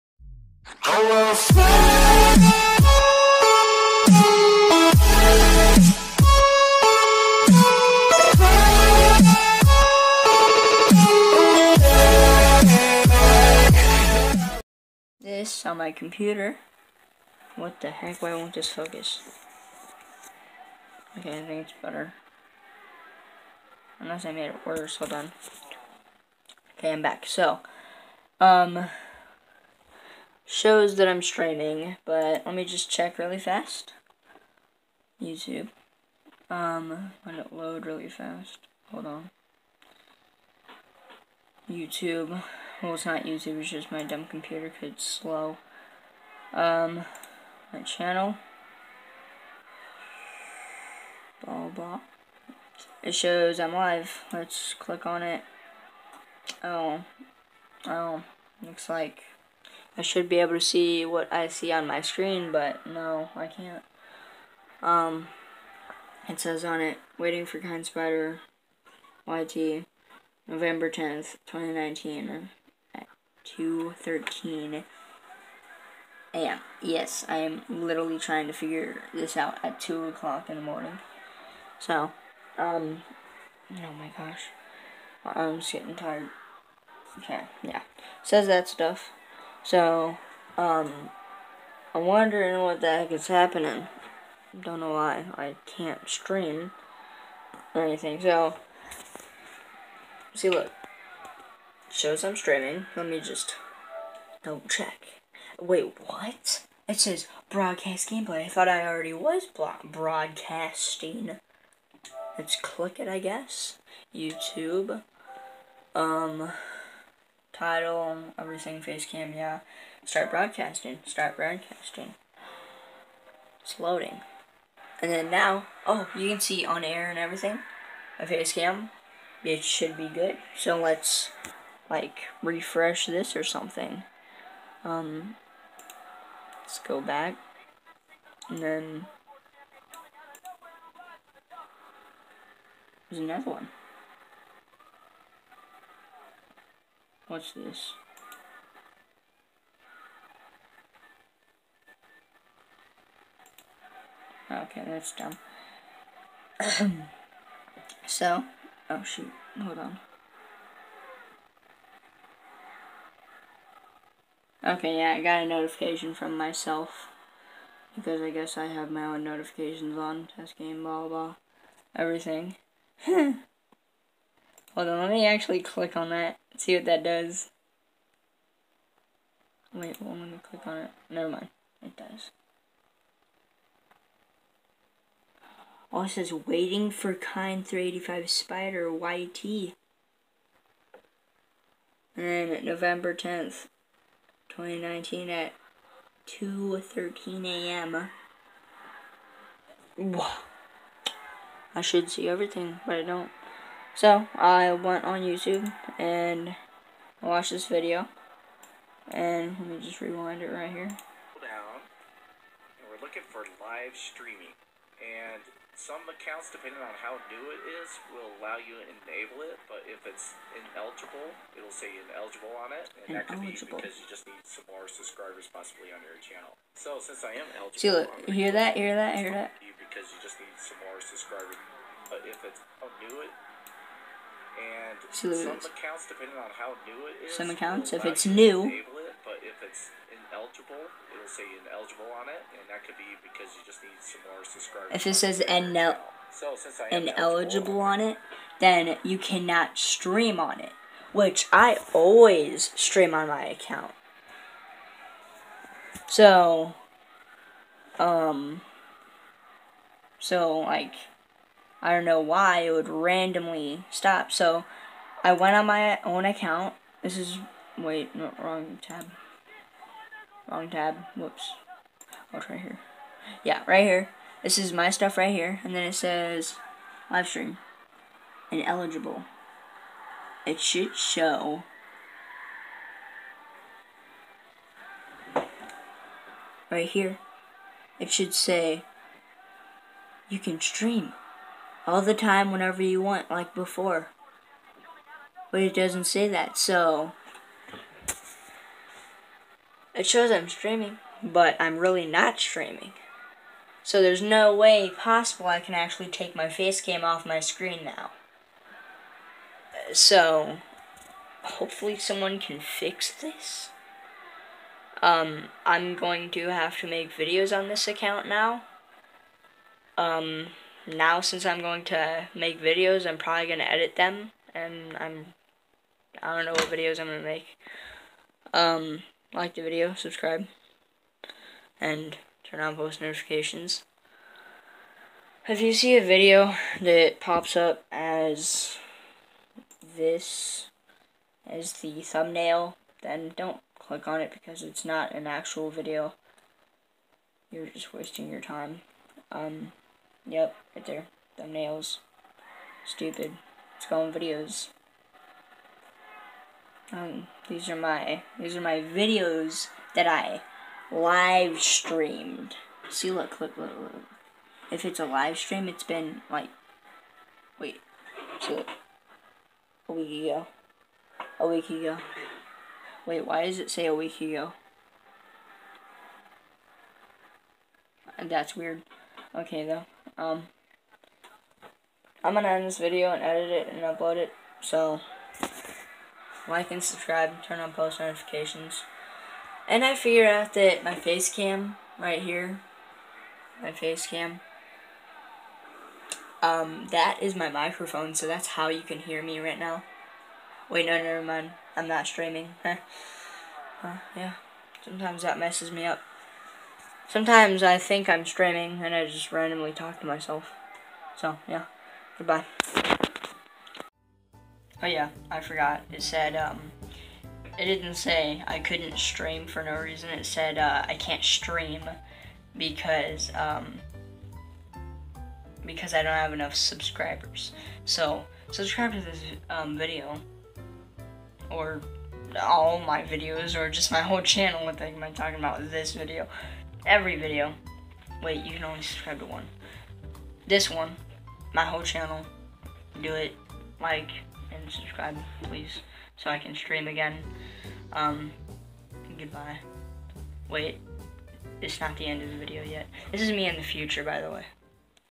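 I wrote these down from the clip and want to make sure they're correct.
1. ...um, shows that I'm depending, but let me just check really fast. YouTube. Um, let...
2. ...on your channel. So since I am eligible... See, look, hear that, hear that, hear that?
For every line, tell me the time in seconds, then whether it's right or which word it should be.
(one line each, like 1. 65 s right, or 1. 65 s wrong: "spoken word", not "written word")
1. 28 s wrong: "streaming", not "depending"
2. 225 s right.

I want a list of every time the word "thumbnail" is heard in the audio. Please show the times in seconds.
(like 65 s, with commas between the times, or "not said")
342 s, 351 s.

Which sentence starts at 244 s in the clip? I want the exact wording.
If it says so ineligible on it, then you cannot stream on it, which I always stream on my account.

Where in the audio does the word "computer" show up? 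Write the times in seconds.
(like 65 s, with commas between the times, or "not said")
15 s, 44 s.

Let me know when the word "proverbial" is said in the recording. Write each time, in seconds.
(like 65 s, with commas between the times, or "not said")
not said.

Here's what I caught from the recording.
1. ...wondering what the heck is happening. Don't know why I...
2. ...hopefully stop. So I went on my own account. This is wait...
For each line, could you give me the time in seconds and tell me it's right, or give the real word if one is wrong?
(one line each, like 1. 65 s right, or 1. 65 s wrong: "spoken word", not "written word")
1. 92 s right
2. 262 s wrong: "randomly", not "hopefully".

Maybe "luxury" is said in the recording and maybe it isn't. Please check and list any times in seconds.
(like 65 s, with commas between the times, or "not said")
not said.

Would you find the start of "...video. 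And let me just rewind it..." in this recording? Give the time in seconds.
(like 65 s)
207 s.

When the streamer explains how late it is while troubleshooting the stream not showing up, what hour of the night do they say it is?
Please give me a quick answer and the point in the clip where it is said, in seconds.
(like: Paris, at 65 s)
2 o'clock, at 79 s.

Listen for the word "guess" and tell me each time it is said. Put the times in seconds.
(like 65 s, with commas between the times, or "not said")
113 s, 168 s.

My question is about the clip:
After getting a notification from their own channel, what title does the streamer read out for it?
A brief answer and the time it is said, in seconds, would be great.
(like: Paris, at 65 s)
Test game, at 170 s.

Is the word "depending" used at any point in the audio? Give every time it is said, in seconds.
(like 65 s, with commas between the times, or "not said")
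216 s, 236 s.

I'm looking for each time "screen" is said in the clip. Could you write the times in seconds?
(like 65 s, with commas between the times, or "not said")
62 s, 307 s.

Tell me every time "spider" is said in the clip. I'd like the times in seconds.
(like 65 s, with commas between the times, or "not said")
67 s, 188 s.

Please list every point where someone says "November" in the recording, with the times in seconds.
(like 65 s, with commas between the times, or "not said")
70 s, 192 s.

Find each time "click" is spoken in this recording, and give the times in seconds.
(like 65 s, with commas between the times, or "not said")
54 s, 112 s, 175 s, 180 s, 343 s.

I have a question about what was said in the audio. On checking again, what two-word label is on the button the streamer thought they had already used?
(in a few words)
Broadcast gameplay.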